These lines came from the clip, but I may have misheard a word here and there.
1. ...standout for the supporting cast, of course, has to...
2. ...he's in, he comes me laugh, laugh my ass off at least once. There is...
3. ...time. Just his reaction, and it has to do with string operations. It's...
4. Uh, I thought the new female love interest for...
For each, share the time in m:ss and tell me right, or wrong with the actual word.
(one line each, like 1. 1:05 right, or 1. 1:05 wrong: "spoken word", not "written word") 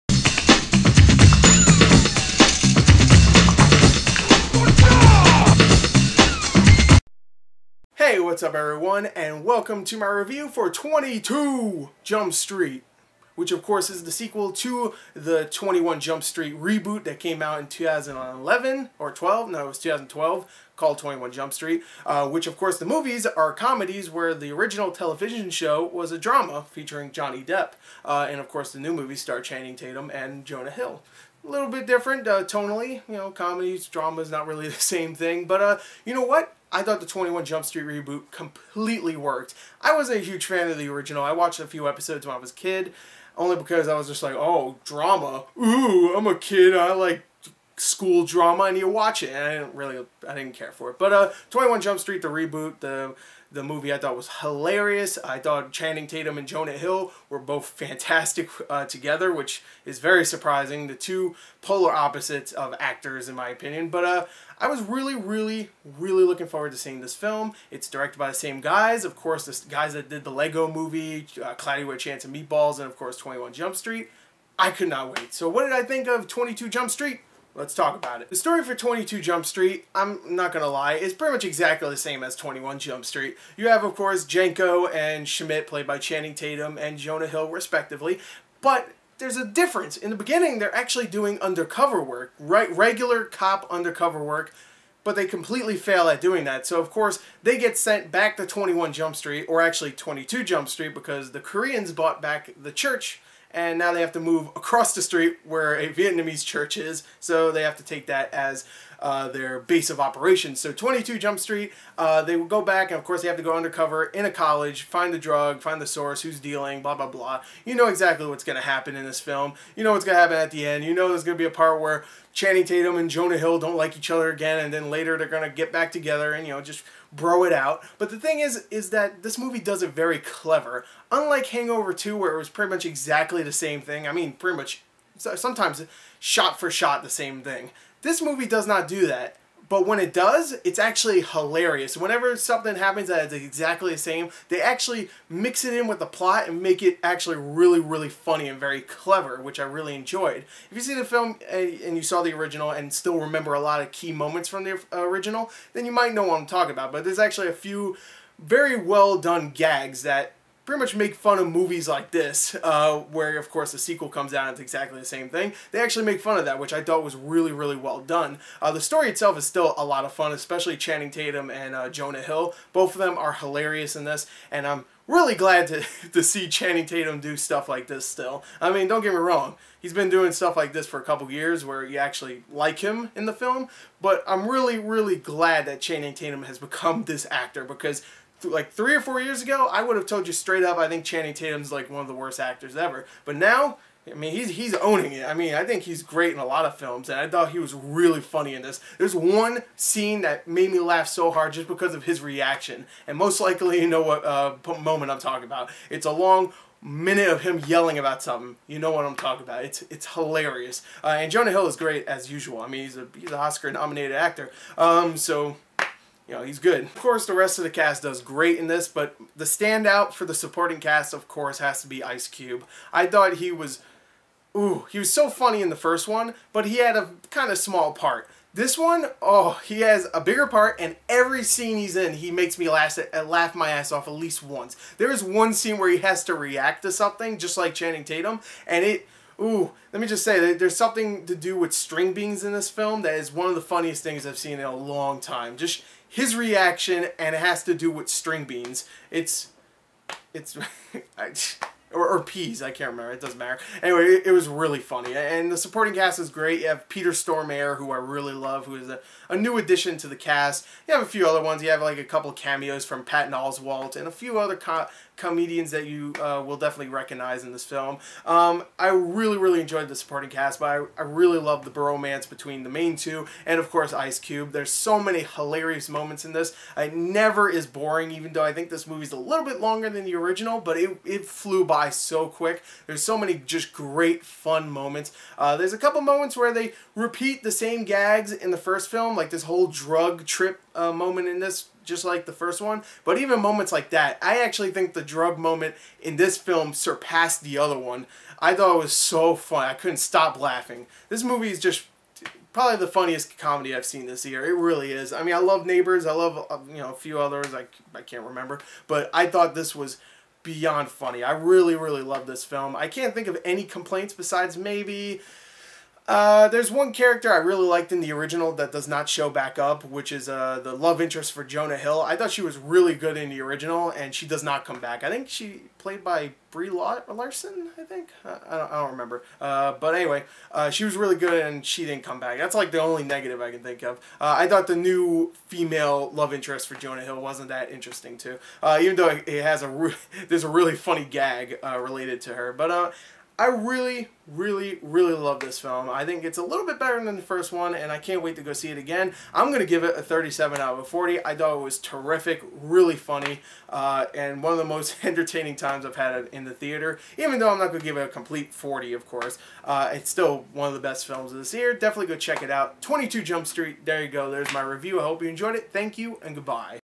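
1. 3:39 right
2. 3:51 wrong: "makes", not "comes"
3. 4:05 wrong: "beans", not "operations"
4. 5:34 right.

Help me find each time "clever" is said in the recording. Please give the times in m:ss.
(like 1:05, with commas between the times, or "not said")
2:10, 2:28.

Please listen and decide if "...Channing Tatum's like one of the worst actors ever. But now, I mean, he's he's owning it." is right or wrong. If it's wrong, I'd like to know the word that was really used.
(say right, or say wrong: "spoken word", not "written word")
right.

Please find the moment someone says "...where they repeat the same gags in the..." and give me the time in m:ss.
4:46.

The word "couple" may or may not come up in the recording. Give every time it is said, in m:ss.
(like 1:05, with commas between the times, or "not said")
3:01, 4:22, 4:45.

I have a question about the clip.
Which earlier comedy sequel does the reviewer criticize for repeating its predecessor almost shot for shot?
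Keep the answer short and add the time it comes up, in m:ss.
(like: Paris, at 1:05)
Hangover 2, at 2:11.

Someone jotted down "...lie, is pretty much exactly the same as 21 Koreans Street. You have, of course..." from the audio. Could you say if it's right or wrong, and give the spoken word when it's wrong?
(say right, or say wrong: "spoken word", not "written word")
wrong: "Jump", not "Koreans".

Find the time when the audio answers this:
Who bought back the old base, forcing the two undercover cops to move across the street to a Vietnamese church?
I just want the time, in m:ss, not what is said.
1:41.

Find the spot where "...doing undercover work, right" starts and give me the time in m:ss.
1:31.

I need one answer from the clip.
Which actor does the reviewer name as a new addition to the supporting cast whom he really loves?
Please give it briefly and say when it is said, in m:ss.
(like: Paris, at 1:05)
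Peter Stormare, at 4:16.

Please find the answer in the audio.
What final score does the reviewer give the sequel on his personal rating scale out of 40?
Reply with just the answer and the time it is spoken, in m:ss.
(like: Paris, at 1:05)
37, at 5:50.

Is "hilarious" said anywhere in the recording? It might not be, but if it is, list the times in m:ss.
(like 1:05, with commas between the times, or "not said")
0:54, 2:21, 2:53, 3:30, 4:35.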